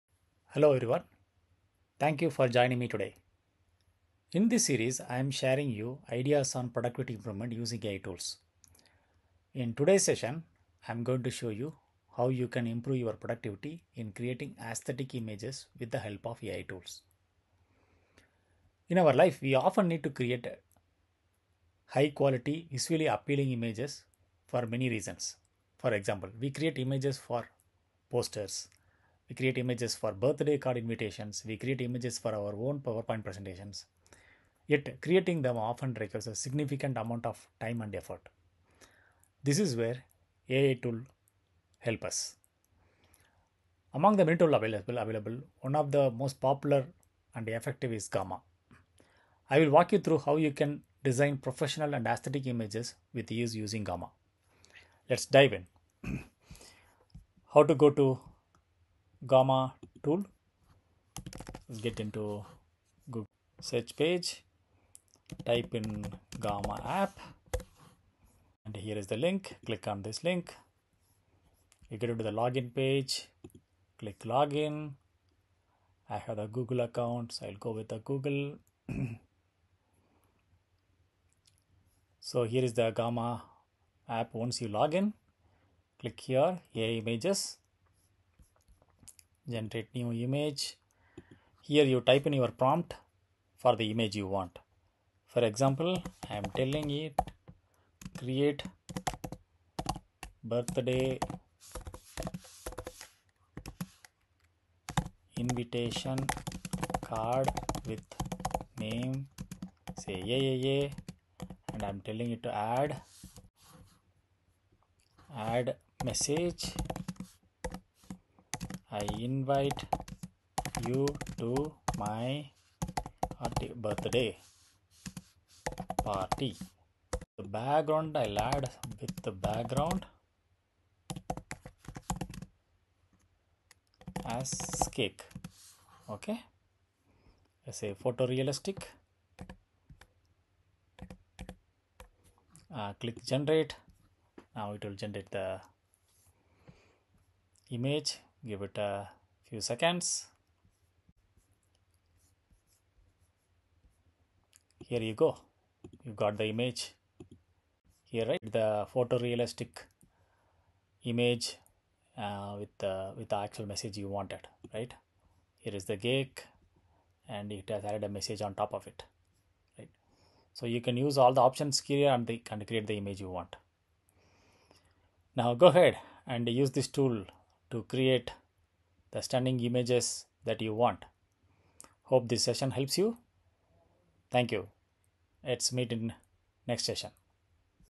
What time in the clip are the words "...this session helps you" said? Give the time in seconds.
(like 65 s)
182 s.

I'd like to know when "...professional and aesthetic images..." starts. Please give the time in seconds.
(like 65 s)
51 s.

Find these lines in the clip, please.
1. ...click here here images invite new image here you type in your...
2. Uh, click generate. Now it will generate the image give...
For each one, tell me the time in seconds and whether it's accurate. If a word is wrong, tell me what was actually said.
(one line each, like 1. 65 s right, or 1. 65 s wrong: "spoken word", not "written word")
1. 85 s wrong: "generate", not "invite"
2. 142 s right.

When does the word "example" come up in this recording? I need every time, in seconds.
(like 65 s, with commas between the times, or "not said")
25 s, 95 s.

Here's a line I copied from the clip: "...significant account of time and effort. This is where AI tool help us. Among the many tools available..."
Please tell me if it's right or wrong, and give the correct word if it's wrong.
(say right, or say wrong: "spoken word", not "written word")
wrong: "amount", not "account".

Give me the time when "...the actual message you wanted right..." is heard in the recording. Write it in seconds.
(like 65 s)
163 s.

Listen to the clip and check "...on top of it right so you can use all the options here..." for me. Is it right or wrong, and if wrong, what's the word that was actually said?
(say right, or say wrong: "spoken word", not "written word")
right.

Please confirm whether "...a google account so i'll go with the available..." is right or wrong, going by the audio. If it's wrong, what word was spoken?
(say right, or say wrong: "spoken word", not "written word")
wrong: "google", not "available".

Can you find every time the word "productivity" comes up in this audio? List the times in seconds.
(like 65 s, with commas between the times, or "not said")
6 s, 13 s.